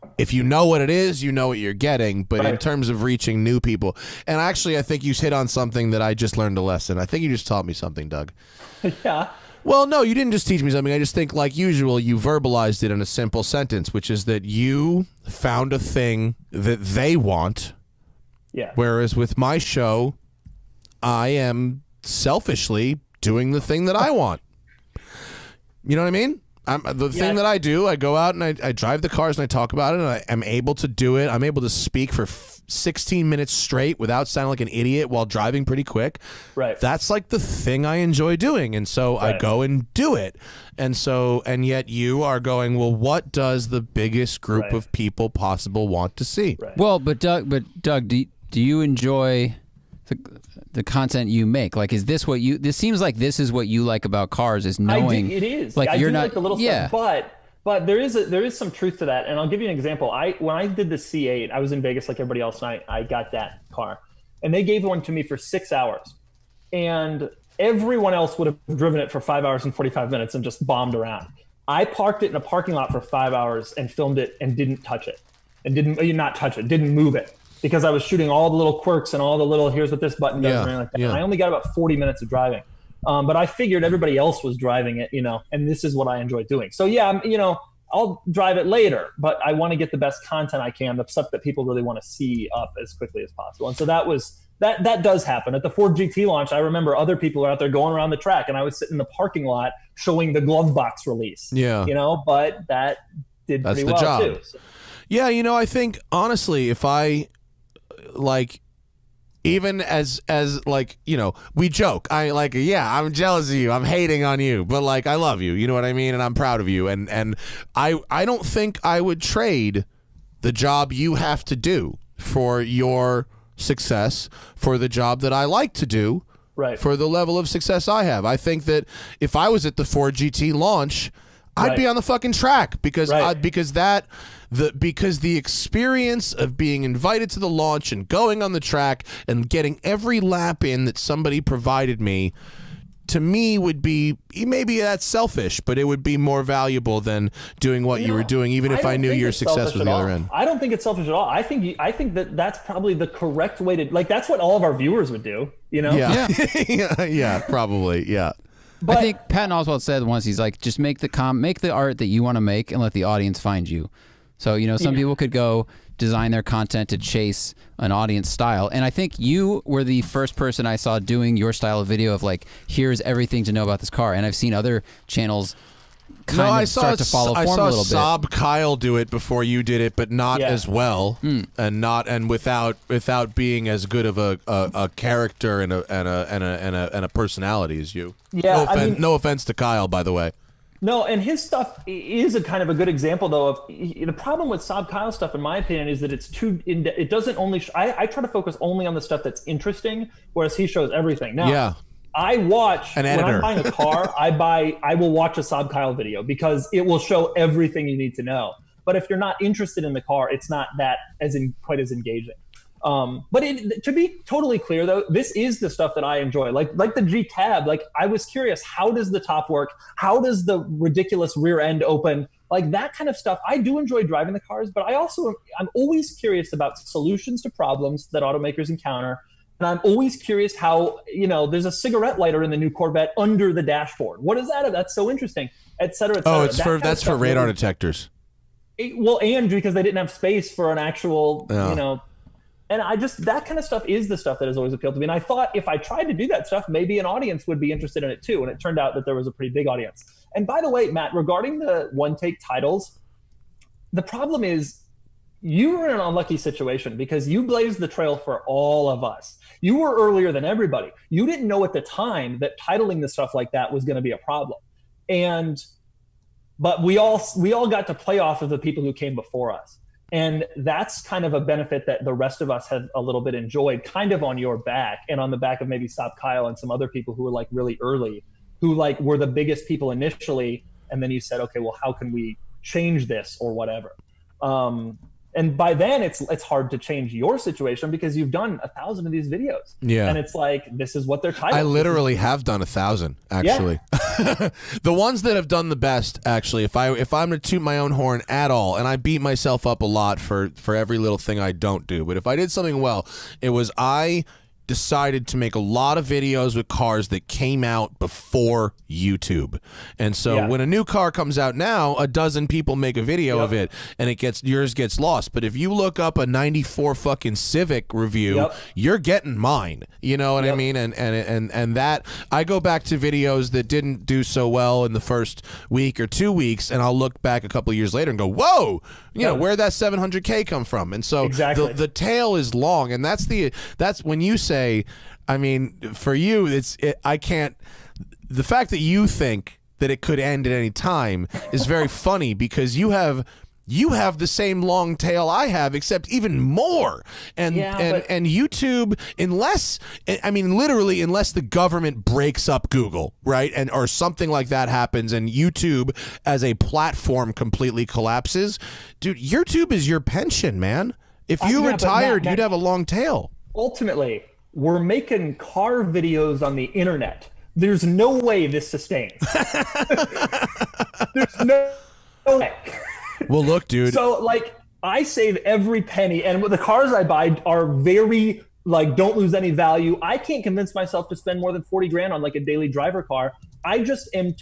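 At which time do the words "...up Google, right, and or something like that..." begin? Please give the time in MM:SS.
05:52.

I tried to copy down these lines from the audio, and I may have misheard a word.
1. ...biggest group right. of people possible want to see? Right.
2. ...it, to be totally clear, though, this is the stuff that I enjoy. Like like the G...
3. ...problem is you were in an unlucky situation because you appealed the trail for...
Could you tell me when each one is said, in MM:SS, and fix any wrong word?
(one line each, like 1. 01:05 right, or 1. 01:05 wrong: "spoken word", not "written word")
1. 00:43 right
2. 03:33 right
3. 04:14 wrong: "blazed", not "appealed".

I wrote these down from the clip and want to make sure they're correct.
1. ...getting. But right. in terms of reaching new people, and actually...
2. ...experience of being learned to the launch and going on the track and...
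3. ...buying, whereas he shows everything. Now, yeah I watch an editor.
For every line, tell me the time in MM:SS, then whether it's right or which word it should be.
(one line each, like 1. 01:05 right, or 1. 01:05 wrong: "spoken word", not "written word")
1. 00:01 right
2. 02:15 wrong: "invited", not "learned"
3. 03:19 wrong: "interesting", not "buying".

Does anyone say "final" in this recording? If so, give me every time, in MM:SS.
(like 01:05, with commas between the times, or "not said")
not said.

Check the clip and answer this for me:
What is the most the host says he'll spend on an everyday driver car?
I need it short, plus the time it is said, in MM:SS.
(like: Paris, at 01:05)
40 grand, at 06:21.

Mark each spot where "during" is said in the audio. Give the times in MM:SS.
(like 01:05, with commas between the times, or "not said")
not said.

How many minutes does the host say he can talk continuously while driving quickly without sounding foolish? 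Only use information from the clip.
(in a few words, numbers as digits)
16.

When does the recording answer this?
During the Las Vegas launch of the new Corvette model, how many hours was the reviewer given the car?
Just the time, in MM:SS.
01:05.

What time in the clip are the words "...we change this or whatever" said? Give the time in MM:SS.
04:42.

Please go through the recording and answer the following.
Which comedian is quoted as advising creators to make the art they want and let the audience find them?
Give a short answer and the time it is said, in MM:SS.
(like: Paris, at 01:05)
Patton Oswalt, at 02:39.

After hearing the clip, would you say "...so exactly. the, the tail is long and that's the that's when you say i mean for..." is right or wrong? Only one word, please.
right.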